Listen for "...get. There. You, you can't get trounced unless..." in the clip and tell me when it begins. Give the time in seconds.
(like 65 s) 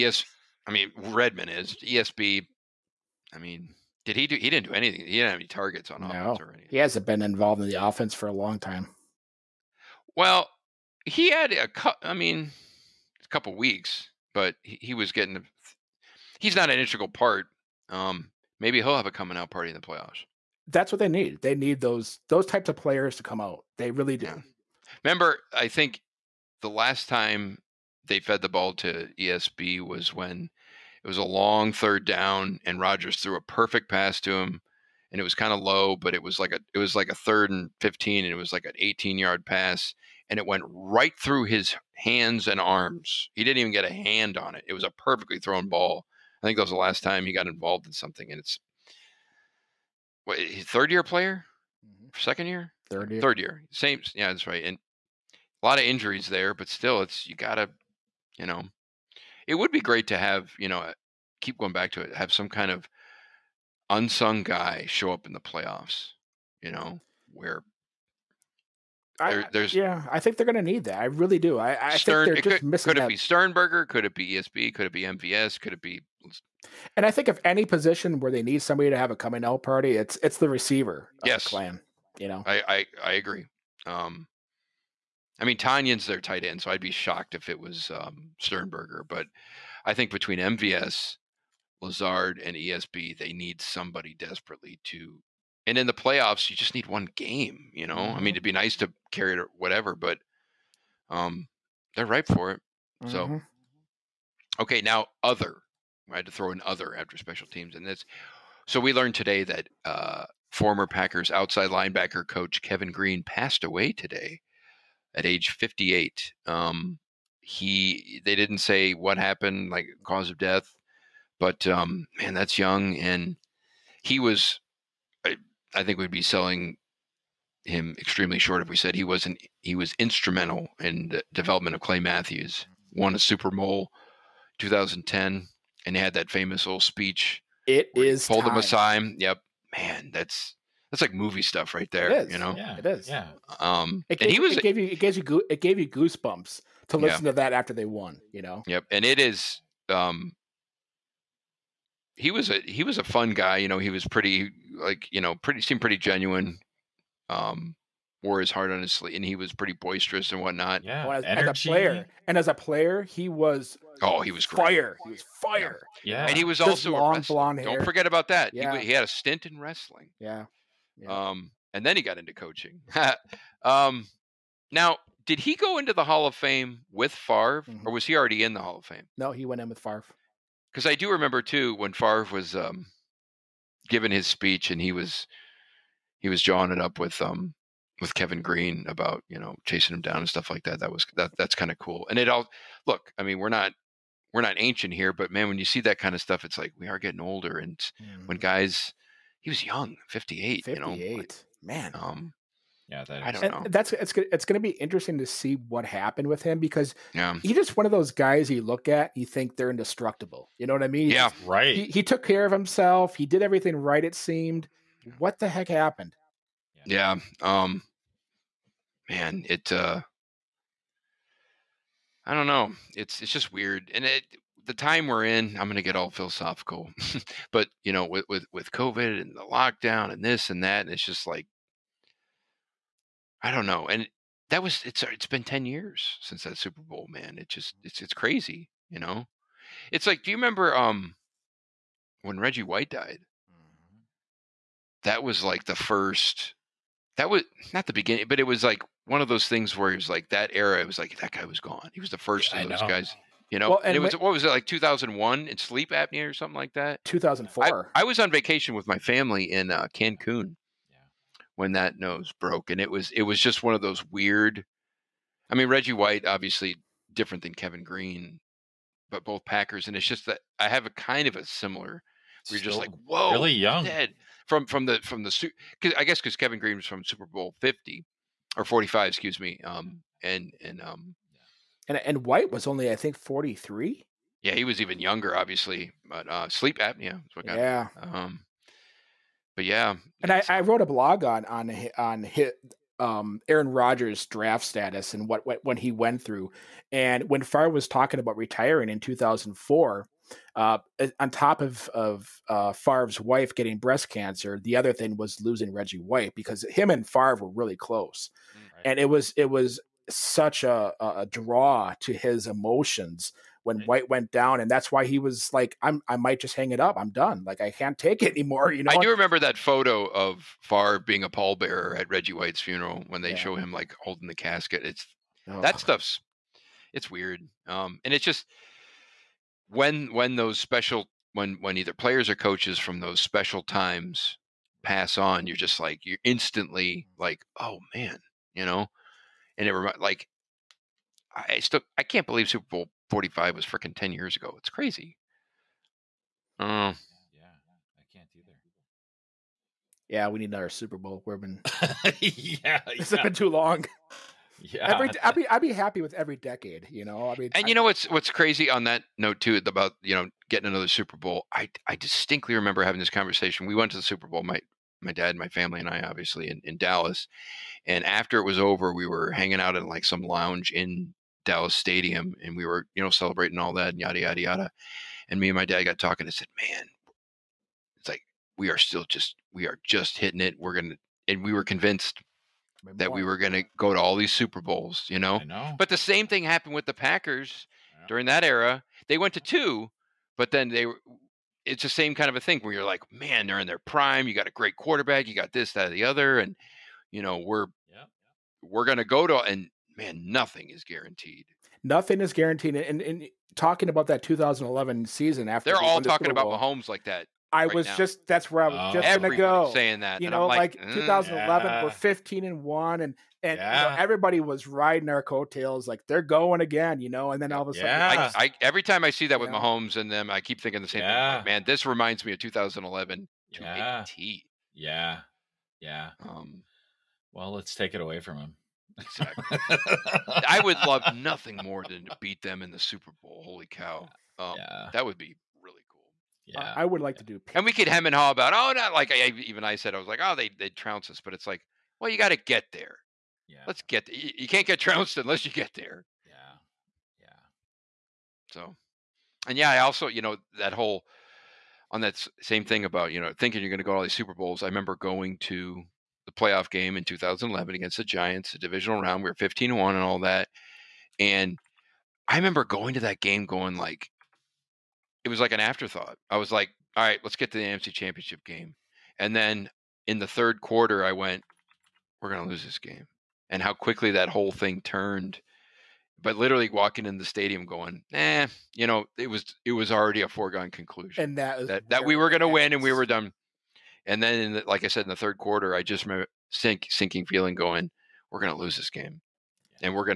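443 s.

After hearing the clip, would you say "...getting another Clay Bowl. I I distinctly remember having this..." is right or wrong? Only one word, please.
wrong.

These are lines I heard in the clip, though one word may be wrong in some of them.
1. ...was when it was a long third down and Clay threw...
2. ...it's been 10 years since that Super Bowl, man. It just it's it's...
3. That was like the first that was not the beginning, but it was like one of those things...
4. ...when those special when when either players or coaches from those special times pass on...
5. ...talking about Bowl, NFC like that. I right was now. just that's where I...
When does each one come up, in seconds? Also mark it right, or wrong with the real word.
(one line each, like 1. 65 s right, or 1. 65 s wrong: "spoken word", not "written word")
1. 29 s wrong: "Rodgers", not "Clay"
2. 235 s right
3. 245 s right
4. 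330 s right
5. 406 s wrong: "Mahomes", not "NFC".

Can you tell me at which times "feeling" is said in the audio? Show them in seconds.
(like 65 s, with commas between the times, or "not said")
487 s.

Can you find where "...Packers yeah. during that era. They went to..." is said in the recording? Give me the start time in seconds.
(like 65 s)
386 s.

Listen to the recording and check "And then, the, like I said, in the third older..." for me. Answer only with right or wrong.
wrong.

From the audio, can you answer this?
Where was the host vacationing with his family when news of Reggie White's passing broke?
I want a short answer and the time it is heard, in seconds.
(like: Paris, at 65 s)
Cancun, at 259 s.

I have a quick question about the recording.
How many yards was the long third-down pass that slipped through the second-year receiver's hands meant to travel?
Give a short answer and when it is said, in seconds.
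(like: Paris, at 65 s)
18, at 38 s.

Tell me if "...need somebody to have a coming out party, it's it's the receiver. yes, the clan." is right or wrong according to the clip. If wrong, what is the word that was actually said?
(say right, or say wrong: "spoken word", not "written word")
right.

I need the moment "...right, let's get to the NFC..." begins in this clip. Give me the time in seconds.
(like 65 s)
467 s.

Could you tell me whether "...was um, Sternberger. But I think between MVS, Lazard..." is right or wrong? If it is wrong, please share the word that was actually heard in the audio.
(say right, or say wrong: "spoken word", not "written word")
right.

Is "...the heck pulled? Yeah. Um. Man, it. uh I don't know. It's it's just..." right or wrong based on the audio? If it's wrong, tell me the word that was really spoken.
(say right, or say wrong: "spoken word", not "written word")
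wrong: "happened", not "pulled".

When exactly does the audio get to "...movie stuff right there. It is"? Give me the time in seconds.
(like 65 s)
141 s.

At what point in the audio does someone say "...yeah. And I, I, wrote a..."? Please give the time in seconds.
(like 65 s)
289 s.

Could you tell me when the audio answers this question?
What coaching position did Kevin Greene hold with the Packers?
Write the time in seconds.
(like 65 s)
111 s.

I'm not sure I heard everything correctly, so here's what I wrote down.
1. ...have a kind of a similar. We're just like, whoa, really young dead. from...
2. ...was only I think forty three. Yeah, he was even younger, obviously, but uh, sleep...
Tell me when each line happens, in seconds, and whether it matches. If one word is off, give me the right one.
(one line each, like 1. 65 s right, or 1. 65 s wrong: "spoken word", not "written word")
1. 270 s right
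2. 282 s right.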